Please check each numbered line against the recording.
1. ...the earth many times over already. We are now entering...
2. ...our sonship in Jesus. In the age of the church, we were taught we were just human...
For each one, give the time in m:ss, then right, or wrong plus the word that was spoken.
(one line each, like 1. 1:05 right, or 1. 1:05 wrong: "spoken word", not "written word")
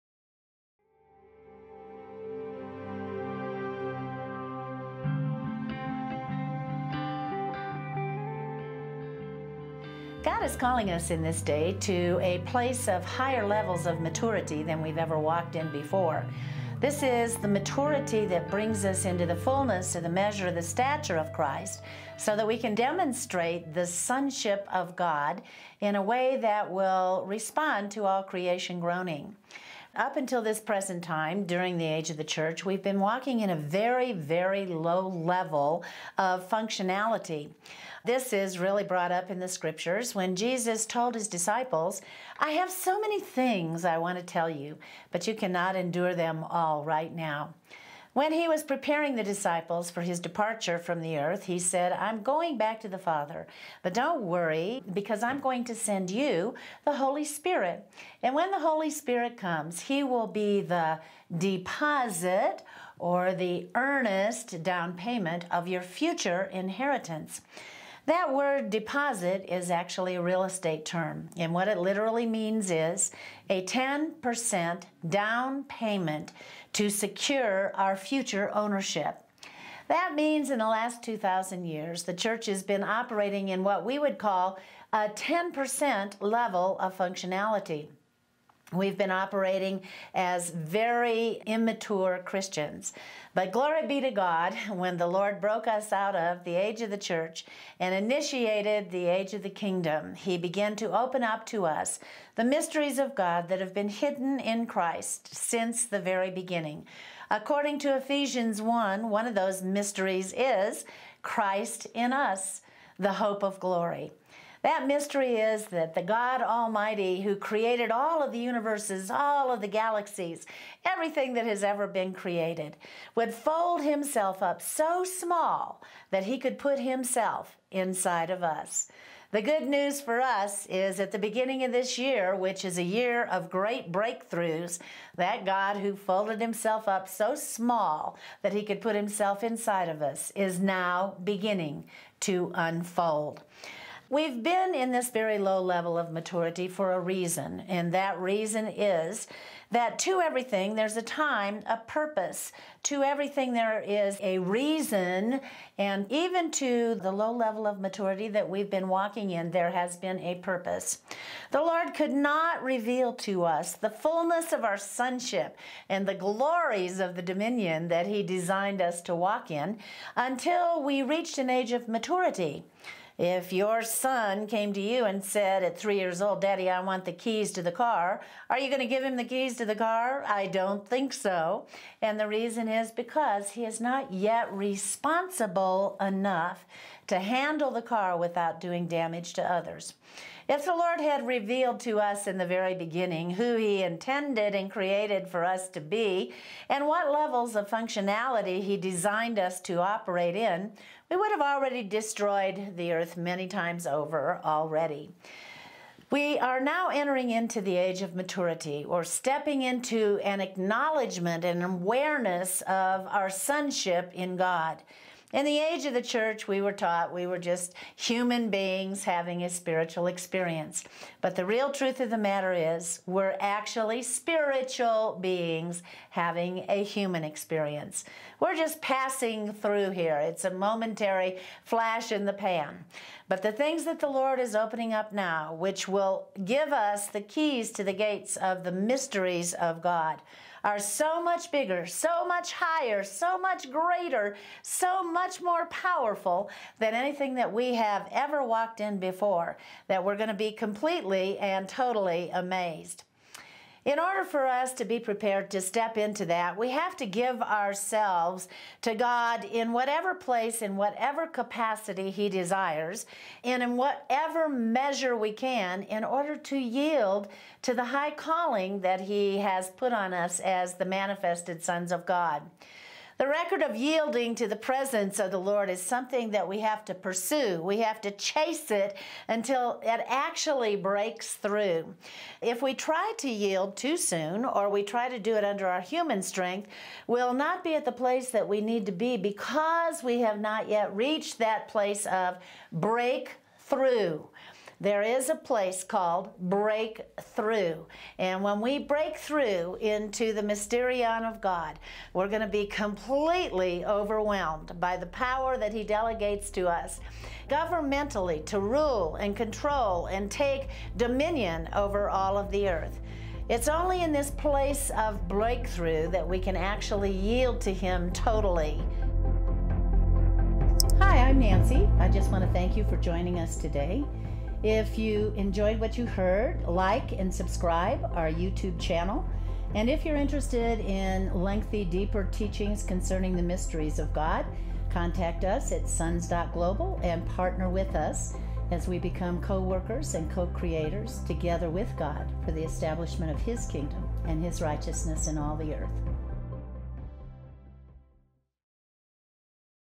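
1. 3:22 right
2. 3:33 wrong: "God", not "Jesus".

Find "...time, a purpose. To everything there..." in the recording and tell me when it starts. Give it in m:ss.
2:31.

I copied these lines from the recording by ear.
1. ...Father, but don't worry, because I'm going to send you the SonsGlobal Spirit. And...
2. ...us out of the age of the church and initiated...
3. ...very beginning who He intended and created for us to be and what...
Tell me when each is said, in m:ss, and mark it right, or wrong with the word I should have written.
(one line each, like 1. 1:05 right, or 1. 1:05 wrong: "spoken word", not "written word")
1. 0:52 wrong: "Holy", not "SonsGlobal"
2. 1:35 right
3. 3:12 right.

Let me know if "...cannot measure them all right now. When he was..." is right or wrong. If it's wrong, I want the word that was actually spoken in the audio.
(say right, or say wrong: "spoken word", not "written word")
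wrong: "endure", not "measure".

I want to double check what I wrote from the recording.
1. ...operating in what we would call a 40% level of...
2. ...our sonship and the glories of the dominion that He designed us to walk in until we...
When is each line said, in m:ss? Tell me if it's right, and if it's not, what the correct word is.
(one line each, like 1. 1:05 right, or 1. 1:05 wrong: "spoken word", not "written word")
1. 1:22 wrong: "10", not "40"
2. 2:44 right.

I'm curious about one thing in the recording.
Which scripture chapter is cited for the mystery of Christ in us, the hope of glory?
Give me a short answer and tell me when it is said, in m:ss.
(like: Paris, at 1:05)
Ephesians 1, at 1:47.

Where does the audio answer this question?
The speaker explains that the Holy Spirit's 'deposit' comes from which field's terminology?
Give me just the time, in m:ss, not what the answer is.
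1:10.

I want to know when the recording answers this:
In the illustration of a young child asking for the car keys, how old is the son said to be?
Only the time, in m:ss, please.
2:55.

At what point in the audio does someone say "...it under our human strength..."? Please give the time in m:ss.
4:45.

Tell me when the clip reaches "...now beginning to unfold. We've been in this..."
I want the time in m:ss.
2:20.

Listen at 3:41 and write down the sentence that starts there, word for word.
But the real truth of the matter is, we're actually spiritual beings having a human experience.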